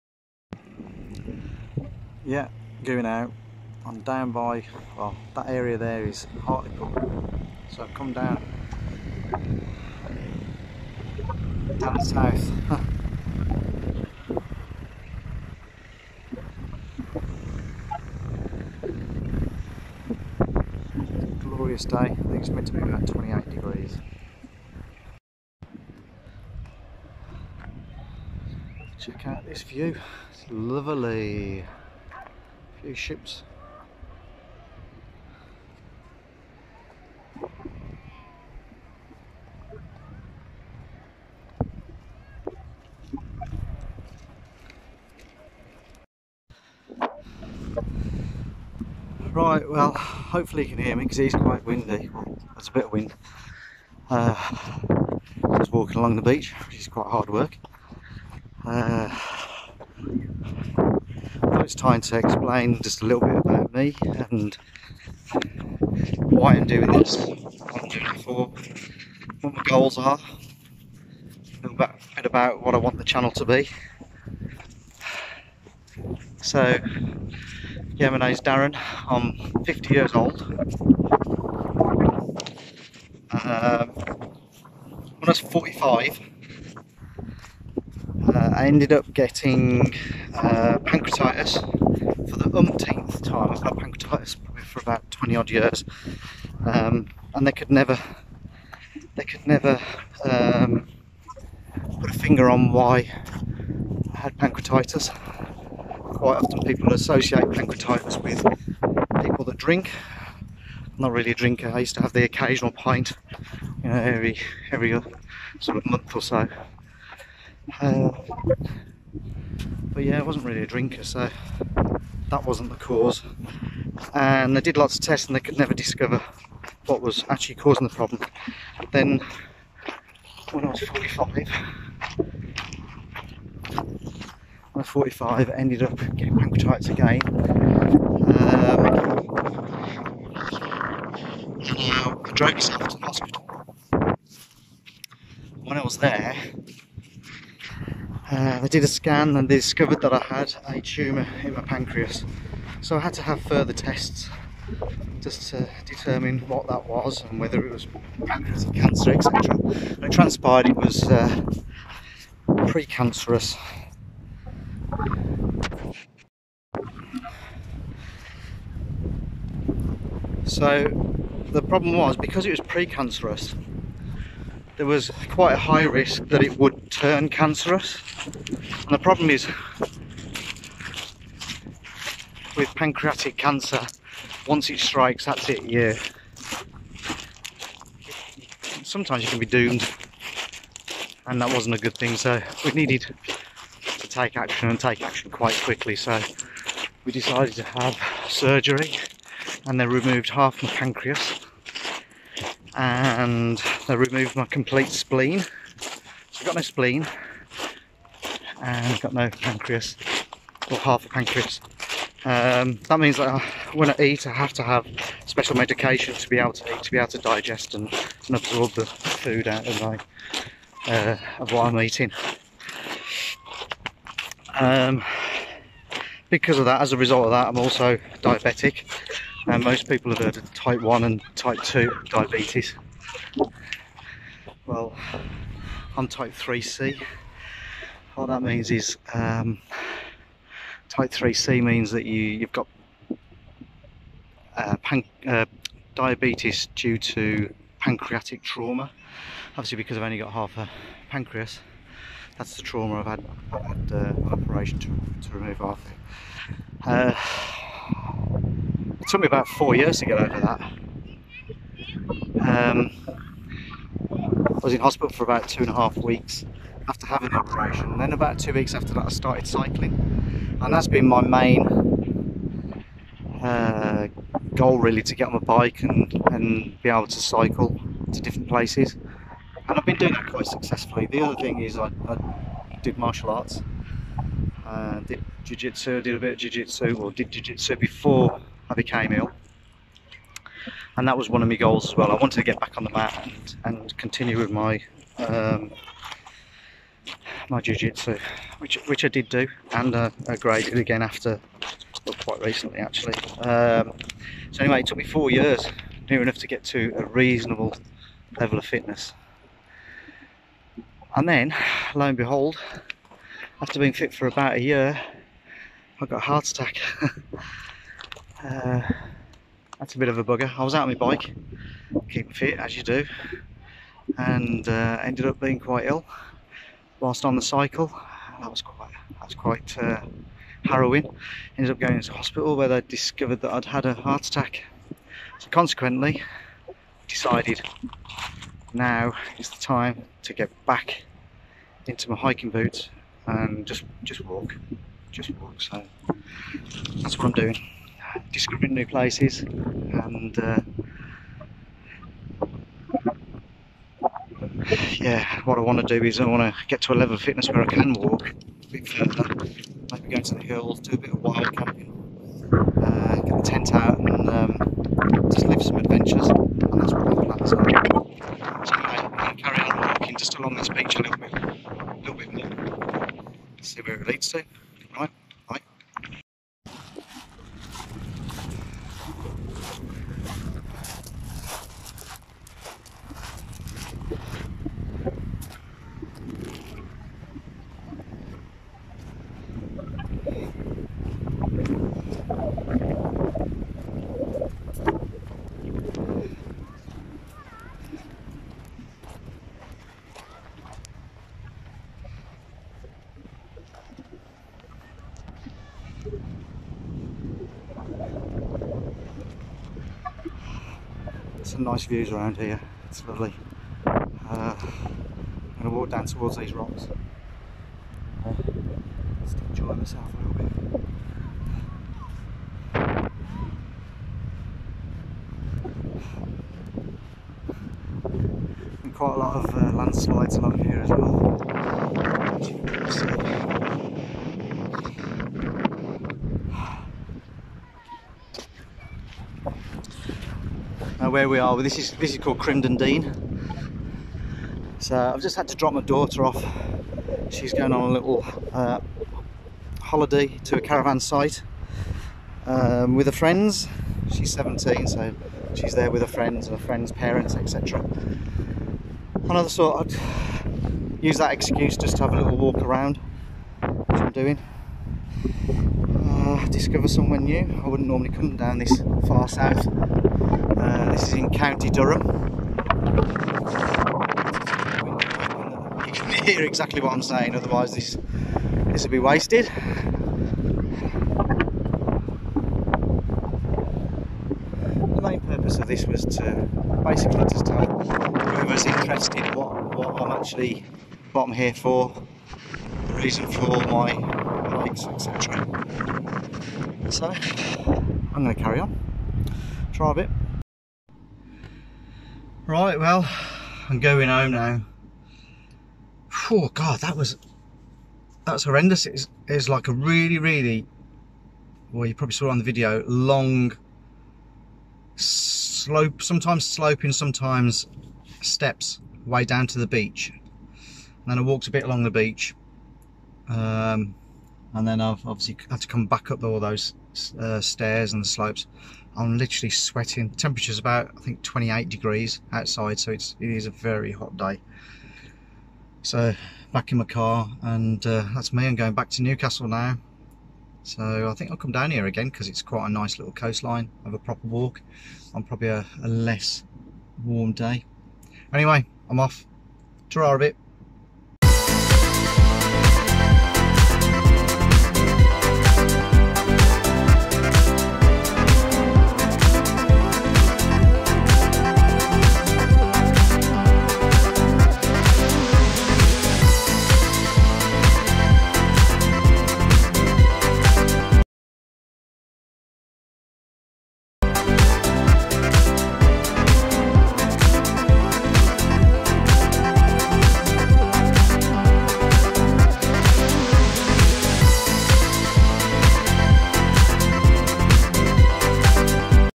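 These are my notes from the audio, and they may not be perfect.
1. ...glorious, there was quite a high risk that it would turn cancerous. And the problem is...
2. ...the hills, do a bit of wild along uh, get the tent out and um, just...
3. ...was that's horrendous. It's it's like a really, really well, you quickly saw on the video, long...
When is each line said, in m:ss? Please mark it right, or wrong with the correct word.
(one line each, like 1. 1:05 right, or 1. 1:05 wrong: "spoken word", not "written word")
1. 2:52 wrong: "precancerous", not "glorious"
2. 6:00 wrong: "camping", not "along"
3. 8:26 wrong: "probably", not "quickly".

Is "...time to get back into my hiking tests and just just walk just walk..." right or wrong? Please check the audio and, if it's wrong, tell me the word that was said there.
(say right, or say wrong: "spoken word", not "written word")
wrong: "boots", not "tests".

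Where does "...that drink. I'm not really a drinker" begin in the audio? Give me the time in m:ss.
1:49.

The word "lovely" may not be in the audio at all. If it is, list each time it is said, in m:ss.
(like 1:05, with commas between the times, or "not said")
0:30, 6:53.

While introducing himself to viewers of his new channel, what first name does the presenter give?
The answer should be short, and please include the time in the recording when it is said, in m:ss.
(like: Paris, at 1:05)
Darren, at 1:18.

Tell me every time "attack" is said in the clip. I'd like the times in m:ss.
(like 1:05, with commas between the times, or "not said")
5:16, 5:34.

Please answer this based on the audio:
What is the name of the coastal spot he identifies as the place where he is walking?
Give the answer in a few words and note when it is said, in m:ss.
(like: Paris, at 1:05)
Crimdon Dene, at 7:22.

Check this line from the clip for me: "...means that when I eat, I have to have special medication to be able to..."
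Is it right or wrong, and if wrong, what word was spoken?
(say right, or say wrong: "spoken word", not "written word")
right.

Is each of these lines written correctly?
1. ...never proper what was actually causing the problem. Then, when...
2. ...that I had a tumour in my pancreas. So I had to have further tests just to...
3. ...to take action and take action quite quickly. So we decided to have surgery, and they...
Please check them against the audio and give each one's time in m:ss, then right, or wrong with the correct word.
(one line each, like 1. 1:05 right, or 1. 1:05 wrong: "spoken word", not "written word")
1. 2:05 wrong: "discover", not "proper"
2. 2:30 right
3. 3:13 right.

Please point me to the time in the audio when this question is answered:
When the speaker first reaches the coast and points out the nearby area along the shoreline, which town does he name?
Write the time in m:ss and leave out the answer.
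0:06.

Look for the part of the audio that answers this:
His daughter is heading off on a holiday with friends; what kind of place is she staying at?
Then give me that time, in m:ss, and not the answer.
7:30.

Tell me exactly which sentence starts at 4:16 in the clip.
Uh, it took me about four years to get over that.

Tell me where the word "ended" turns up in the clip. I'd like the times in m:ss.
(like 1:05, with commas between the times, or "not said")
1:28, 2:15, 5:25, 5:31.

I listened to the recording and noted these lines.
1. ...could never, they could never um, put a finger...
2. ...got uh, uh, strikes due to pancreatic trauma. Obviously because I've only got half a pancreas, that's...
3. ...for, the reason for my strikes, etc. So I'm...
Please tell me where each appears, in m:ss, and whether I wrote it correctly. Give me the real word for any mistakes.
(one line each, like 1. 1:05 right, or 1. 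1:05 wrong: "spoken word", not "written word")
1. 1:37 right
2. 4:02 wrong: "diabetes", not "strikes"
3. 8:11 wrong: "likes", not "strikes".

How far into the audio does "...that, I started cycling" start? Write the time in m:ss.
4:28.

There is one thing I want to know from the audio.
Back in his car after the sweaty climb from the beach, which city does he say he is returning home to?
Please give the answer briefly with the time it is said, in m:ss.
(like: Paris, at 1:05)
Newcastle, at 8:59.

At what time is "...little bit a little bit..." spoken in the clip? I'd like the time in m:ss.
6:11.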